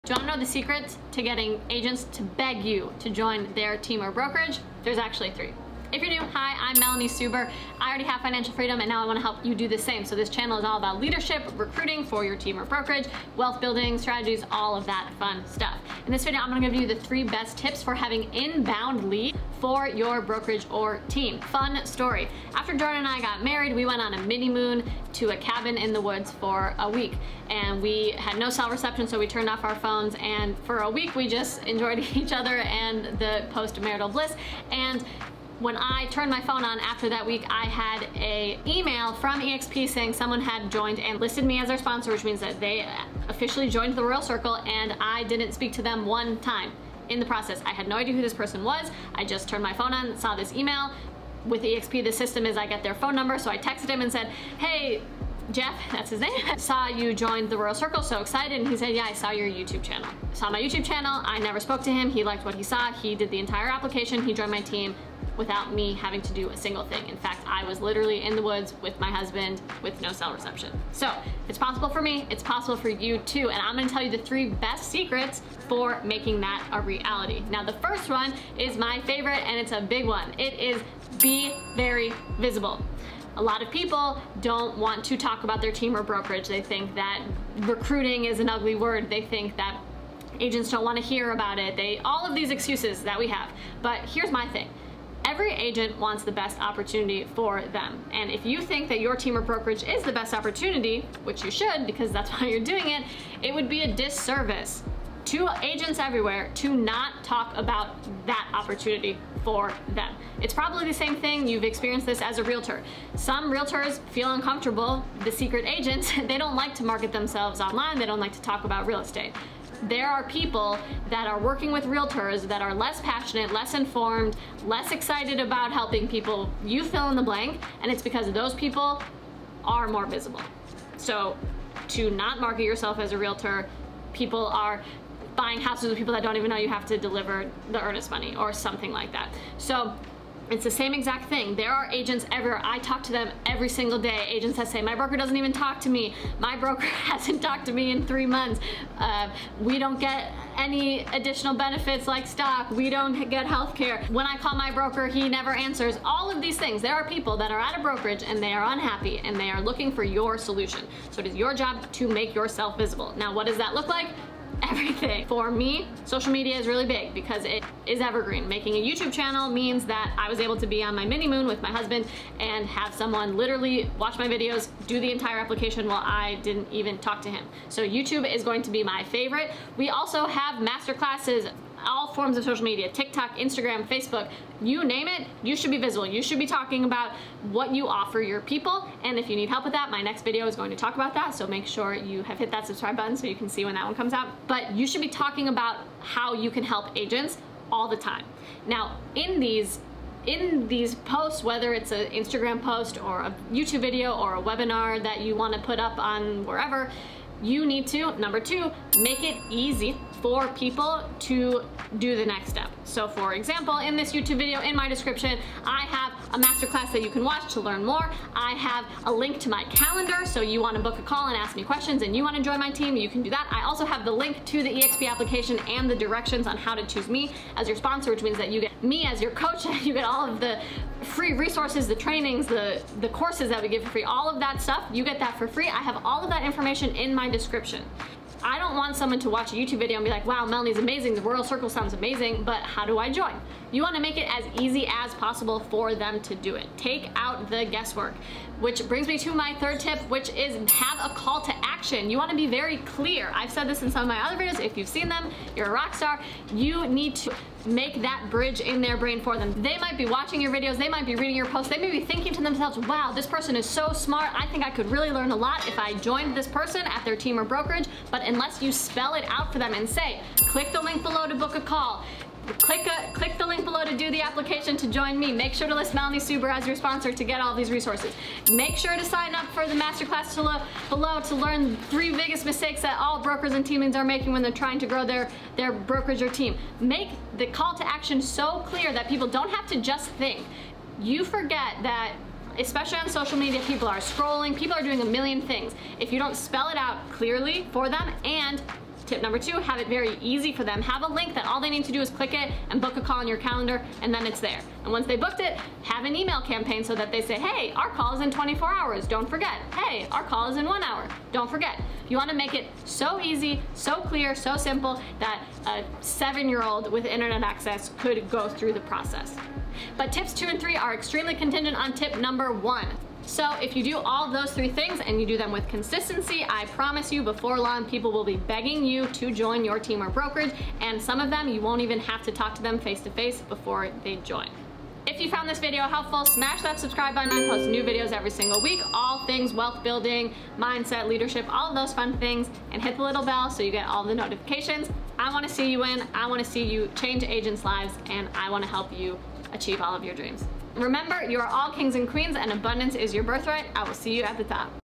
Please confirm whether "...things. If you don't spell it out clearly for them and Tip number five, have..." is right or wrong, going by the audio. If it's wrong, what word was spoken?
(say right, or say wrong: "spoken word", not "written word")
wrong: "two", not "five".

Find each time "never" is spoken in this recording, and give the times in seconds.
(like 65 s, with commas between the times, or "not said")
61 s, 155 s.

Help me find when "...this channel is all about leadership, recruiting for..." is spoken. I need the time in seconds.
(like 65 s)
10 s.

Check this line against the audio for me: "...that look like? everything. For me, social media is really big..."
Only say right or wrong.
right.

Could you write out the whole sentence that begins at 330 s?
And some of them, you won't even have to talk to them face to face before they join.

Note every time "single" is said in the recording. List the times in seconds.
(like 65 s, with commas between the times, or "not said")
66 s, 143 s, 338 s.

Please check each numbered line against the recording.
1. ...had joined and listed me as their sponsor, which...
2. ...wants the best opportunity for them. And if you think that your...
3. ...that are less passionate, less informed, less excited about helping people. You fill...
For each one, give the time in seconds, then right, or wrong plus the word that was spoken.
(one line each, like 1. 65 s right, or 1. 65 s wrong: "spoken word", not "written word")
1. 40 s right
2. 95 s right
3. 122 s right.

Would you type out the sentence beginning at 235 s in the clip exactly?
I have all of that information in my description.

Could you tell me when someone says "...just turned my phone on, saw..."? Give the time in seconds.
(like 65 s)
49 s.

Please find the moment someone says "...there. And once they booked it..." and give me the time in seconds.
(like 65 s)
304 s.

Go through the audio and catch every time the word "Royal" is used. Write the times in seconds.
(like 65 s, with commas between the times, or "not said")
44 s, 57 s, 241 s.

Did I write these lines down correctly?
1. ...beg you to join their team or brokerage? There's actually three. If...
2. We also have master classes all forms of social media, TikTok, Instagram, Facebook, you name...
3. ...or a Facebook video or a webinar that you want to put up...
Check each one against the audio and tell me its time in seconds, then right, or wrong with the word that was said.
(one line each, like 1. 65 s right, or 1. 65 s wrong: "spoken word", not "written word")
1. 2 s right
2. 179 s right
3. 203 s wrong: "YouTube", not "Facebook".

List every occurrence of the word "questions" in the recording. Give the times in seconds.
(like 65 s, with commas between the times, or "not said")
221 s.